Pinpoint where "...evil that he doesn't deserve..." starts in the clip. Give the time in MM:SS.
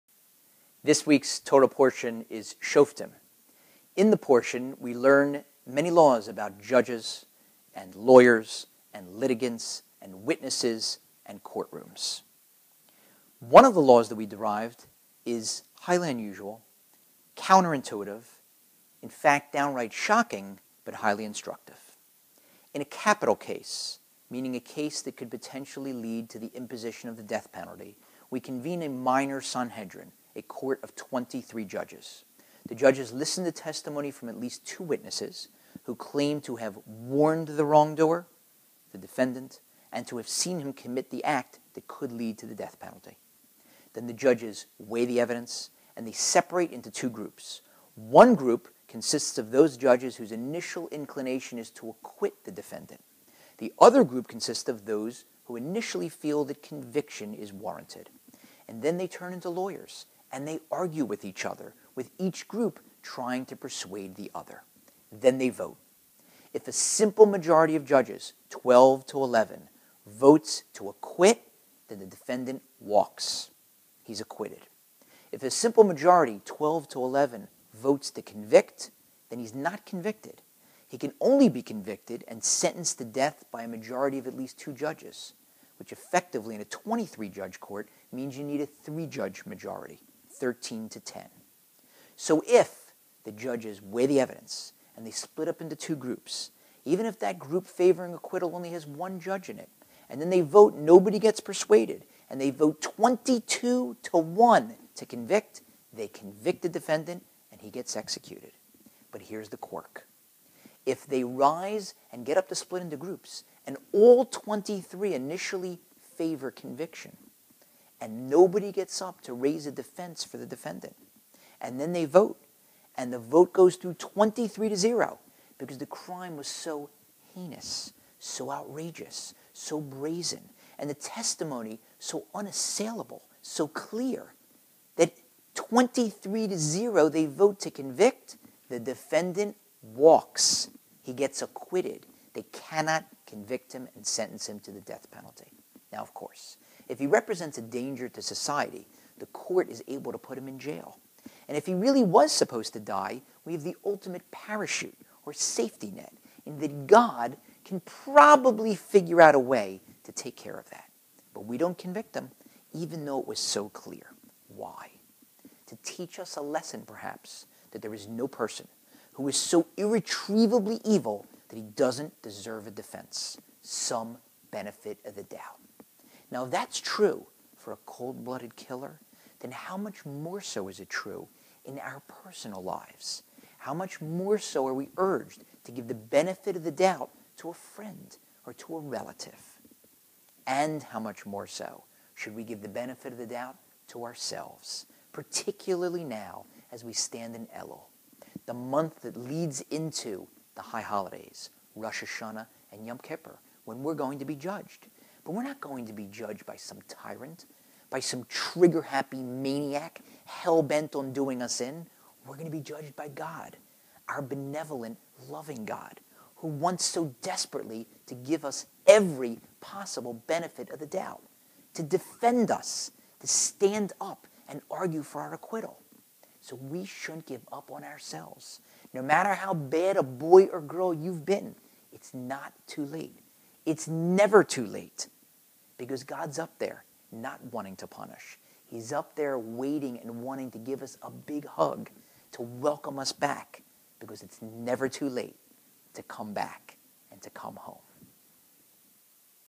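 02:50.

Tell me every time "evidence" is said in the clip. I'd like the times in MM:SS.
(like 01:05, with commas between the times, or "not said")
00:45, 01:34.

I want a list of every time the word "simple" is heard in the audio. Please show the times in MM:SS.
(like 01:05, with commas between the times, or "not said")
01:06, 01:15.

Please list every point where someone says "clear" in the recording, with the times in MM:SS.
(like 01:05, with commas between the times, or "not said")
02:13, 02:43.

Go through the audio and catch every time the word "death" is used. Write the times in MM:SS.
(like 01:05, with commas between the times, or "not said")
00:27, 00:42, 01:23, 02:24.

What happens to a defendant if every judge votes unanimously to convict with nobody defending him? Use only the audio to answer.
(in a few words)
He gets acquitted.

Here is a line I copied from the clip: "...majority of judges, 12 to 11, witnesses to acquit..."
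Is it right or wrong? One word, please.
wrong.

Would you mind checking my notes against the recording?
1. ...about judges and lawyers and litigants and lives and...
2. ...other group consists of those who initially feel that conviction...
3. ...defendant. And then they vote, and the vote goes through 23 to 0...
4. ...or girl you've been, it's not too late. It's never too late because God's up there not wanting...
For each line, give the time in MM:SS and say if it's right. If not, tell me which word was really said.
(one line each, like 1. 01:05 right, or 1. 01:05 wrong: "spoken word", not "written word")
1. 00:06 wrong: "witnesses", not "lives"
2. 00:53 right
3. 02:00 right
4. 03:50 right.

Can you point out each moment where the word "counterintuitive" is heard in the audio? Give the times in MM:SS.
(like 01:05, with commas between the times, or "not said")
00:17.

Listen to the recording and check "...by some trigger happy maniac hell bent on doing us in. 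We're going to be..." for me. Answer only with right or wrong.
right.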